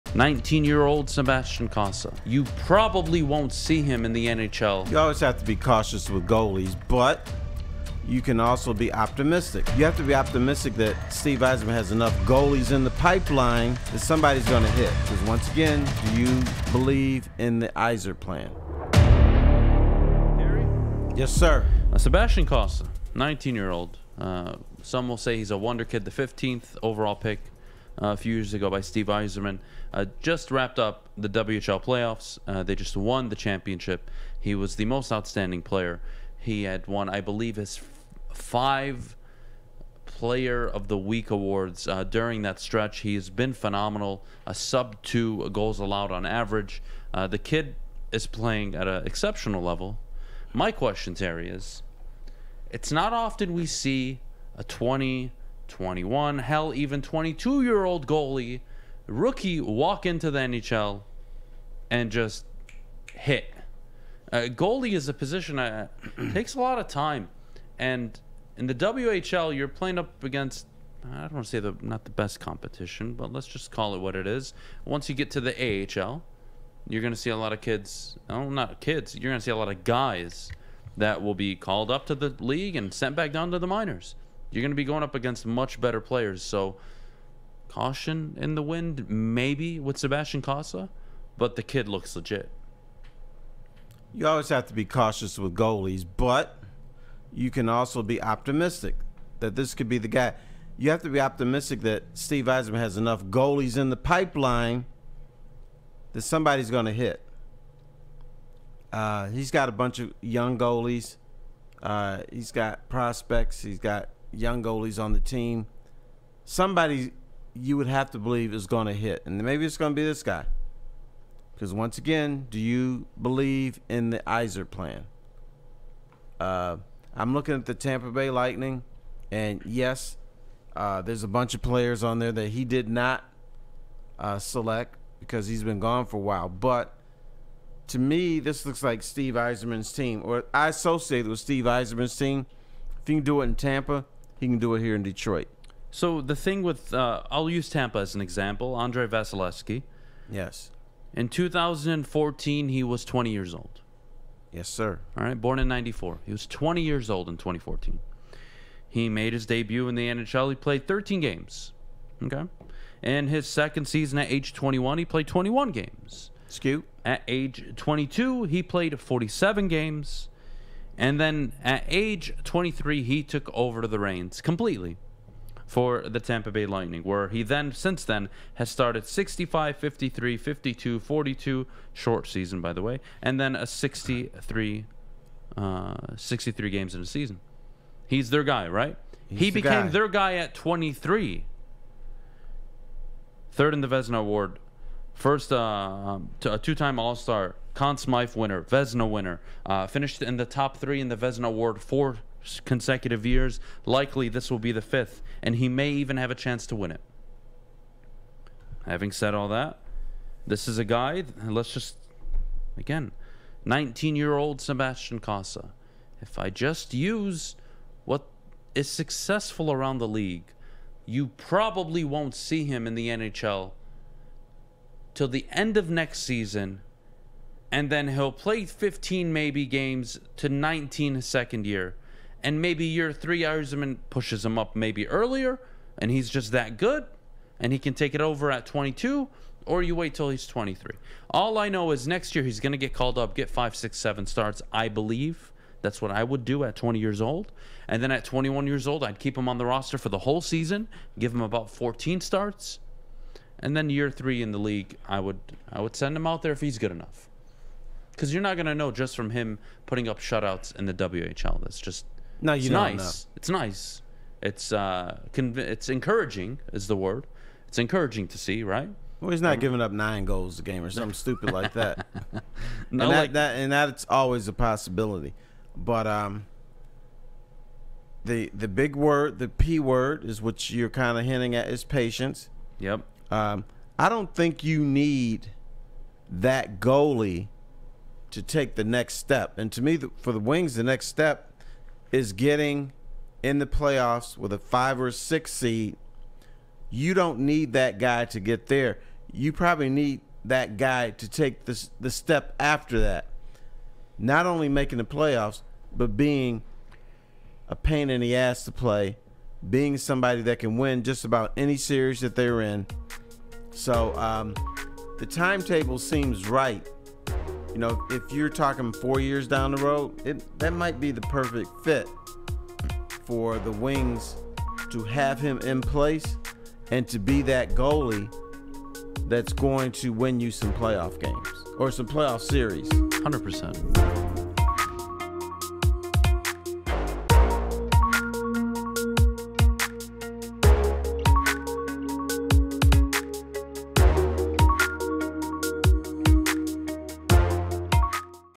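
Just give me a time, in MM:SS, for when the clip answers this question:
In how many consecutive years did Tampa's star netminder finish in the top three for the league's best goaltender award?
03:21.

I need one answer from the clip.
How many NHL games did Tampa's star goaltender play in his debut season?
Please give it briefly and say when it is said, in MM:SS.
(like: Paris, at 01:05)
13, at 02:40.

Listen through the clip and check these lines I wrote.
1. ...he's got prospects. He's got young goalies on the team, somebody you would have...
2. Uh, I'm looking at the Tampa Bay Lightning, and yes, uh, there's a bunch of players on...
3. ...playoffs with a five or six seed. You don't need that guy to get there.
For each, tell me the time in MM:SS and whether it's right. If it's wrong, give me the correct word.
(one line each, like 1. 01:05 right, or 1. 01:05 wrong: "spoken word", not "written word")
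1. 01:52 right
2. 02:06 right
3. 04:53 right.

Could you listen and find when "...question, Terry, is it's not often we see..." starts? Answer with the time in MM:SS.
00:50.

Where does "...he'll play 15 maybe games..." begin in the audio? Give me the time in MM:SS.
03:48.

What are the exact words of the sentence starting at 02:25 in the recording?
So the thing with, uh, I'll use Tampa as an example.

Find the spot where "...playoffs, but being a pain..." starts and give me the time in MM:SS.
05:05.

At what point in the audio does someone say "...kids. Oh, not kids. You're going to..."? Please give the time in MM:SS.
01:17.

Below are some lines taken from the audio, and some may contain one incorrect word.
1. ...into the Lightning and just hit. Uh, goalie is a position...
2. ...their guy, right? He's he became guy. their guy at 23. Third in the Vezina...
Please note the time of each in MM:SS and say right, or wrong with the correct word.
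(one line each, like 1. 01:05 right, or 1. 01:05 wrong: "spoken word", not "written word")
1. 01:00 wrong: "NHL", not "Lightning"
2. 03:08 right.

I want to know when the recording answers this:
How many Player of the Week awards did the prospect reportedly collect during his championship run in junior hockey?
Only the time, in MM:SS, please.
00:38.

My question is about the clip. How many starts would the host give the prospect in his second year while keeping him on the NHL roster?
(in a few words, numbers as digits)
14.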